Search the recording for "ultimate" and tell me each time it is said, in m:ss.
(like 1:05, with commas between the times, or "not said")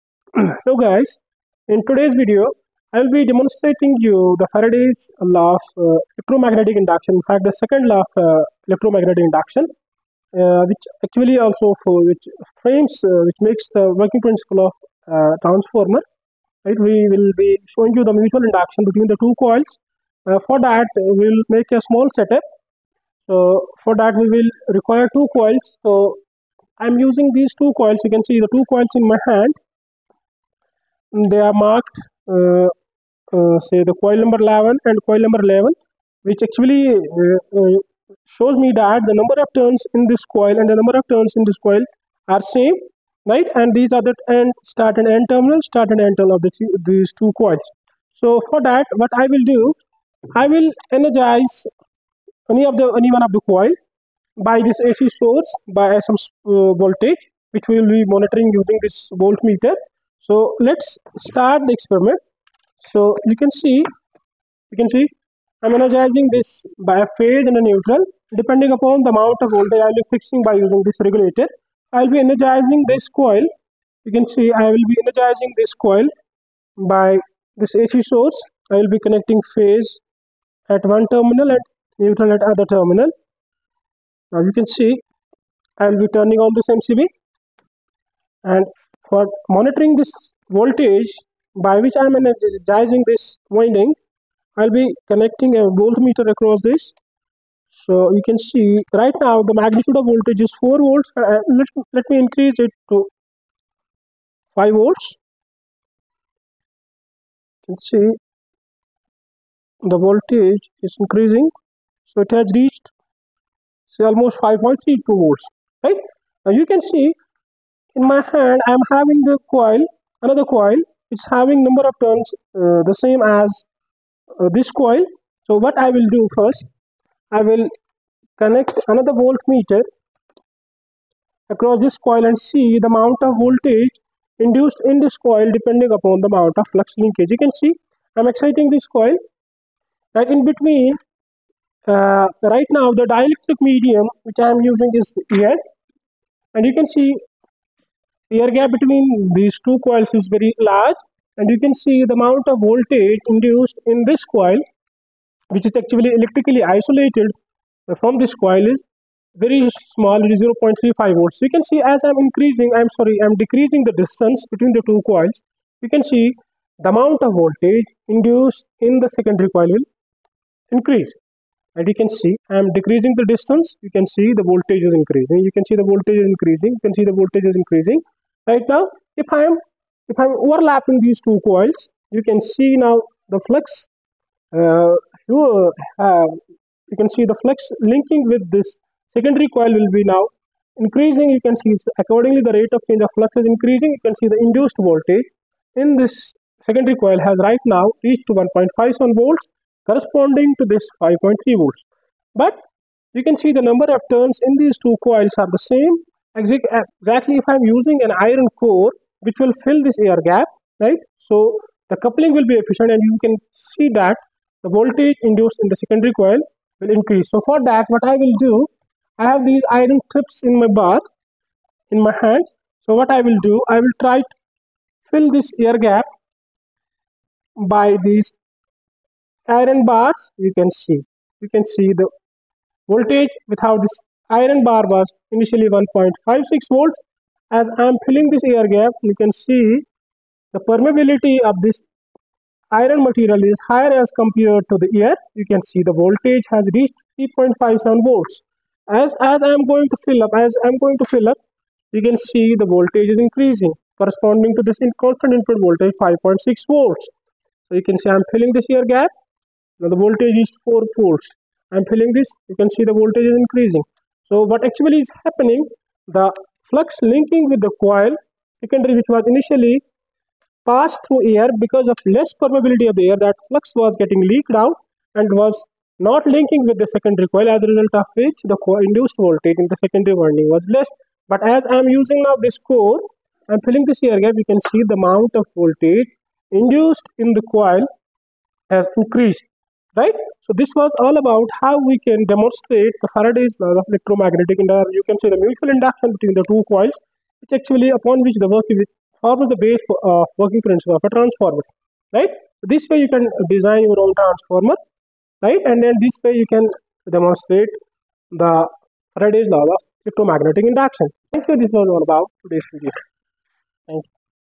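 not said.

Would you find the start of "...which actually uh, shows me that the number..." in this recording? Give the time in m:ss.
0:36.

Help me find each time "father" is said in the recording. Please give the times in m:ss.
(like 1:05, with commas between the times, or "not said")
not said.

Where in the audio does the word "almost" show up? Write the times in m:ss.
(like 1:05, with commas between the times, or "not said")
1:54.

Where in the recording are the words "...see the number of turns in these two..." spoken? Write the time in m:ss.
3:23.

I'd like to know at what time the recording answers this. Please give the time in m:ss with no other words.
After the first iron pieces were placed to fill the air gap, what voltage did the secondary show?
4:07.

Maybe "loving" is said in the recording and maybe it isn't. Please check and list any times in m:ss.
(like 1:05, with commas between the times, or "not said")
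not said.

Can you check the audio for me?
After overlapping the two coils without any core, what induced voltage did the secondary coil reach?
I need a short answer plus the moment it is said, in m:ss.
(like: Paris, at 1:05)
1.57 volts, at 3:18.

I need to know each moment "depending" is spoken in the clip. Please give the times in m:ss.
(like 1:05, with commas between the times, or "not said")
1:08, 2:15.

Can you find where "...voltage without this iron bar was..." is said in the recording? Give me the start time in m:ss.
3:52.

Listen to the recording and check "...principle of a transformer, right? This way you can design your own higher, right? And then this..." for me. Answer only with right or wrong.
wrong.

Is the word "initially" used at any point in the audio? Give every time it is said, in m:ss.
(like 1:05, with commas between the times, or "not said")
3:55, 4:29.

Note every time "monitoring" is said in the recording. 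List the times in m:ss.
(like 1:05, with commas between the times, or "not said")
0:58, 1:29.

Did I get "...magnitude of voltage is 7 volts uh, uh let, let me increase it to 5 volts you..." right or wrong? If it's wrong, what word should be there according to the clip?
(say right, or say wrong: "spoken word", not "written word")
wrong: "4", not "7".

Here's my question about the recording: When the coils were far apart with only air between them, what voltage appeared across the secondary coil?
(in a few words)
0.35 volts.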